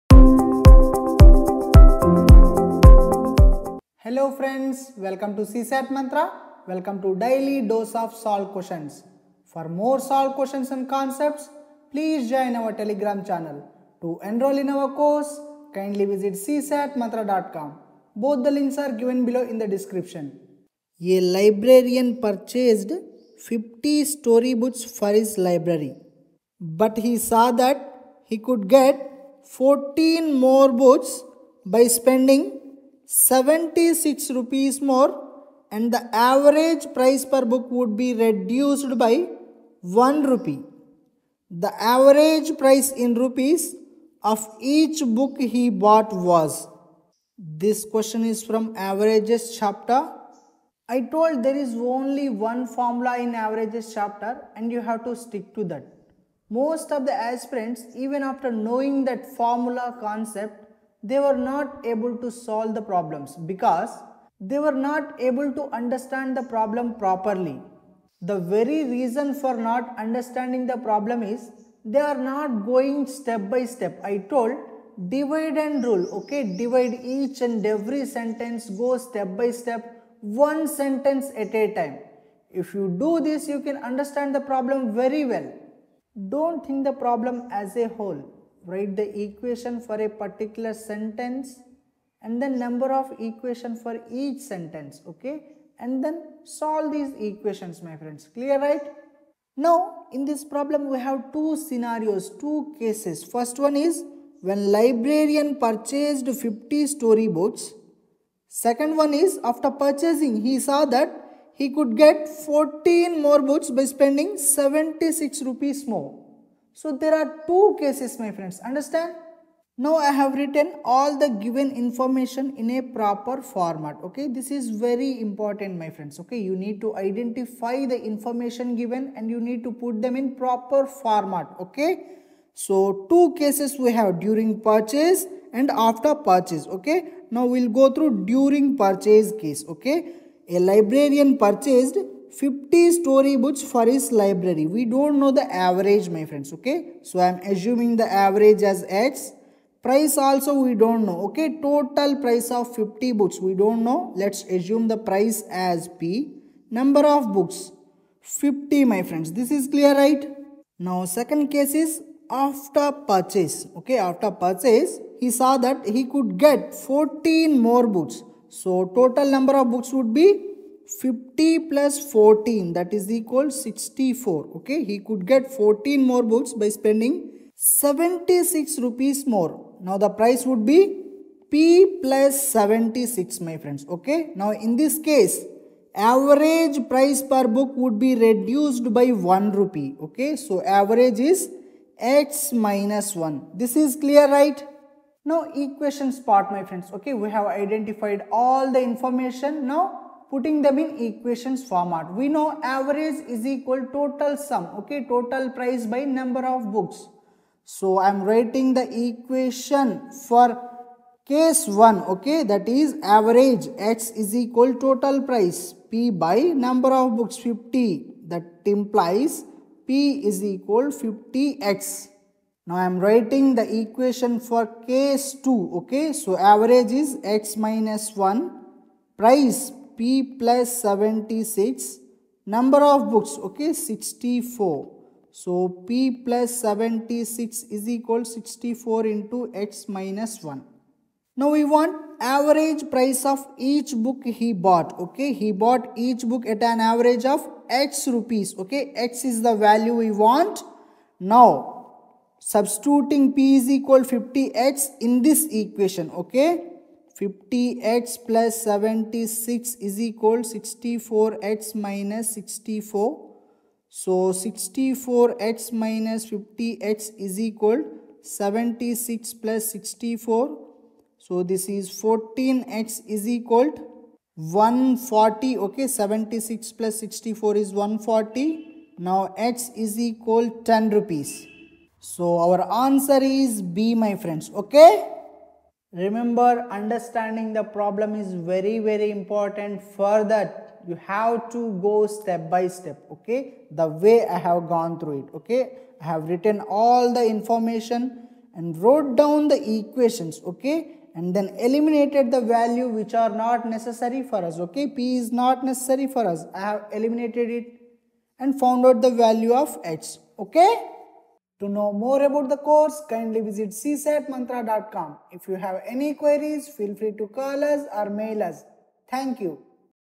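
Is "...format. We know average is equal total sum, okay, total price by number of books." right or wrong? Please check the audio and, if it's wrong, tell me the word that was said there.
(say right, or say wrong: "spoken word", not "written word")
right.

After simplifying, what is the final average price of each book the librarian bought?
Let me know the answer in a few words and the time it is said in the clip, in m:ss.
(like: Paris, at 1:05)
10 rupees, at 4:40.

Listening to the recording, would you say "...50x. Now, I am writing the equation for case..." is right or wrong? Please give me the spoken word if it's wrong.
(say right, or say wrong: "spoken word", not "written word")
right.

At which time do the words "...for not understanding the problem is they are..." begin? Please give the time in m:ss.
1:09.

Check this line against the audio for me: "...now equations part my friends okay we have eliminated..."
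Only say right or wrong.
wrong.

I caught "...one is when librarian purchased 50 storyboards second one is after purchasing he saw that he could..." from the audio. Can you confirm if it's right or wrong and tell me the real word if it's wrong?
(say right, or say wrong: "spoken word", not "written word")
right.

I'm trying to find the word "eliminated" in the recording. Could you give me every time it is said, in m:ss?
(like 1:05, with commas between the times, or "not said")
5:01, 5:06.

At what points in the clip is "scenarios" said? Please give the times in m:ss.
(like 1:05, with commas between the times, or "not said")
1:41.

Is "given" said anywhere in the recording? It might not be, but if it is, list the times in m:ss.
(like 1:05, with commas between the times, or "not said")
0:18, 2:01, 2:08.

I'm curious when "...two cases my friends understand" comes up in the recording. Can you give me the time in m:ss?
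1:57.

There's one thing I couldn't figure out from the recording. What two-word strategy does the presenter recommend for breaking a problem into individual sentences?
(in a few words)
Divide and rule.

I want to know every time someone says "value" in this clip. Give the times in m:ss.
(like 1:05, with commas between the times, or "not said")
4:09, 5:02, 5:09.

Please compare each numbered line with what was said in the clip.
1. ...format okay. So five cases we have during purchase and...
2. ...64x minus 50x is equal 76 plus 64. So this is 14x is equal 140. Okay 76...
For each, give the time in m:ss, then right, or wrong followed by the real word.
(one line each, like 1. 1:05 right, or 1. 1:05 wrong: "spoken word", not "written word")
1. 2:10 wrong: "two", not "five"
2. 4:24 right.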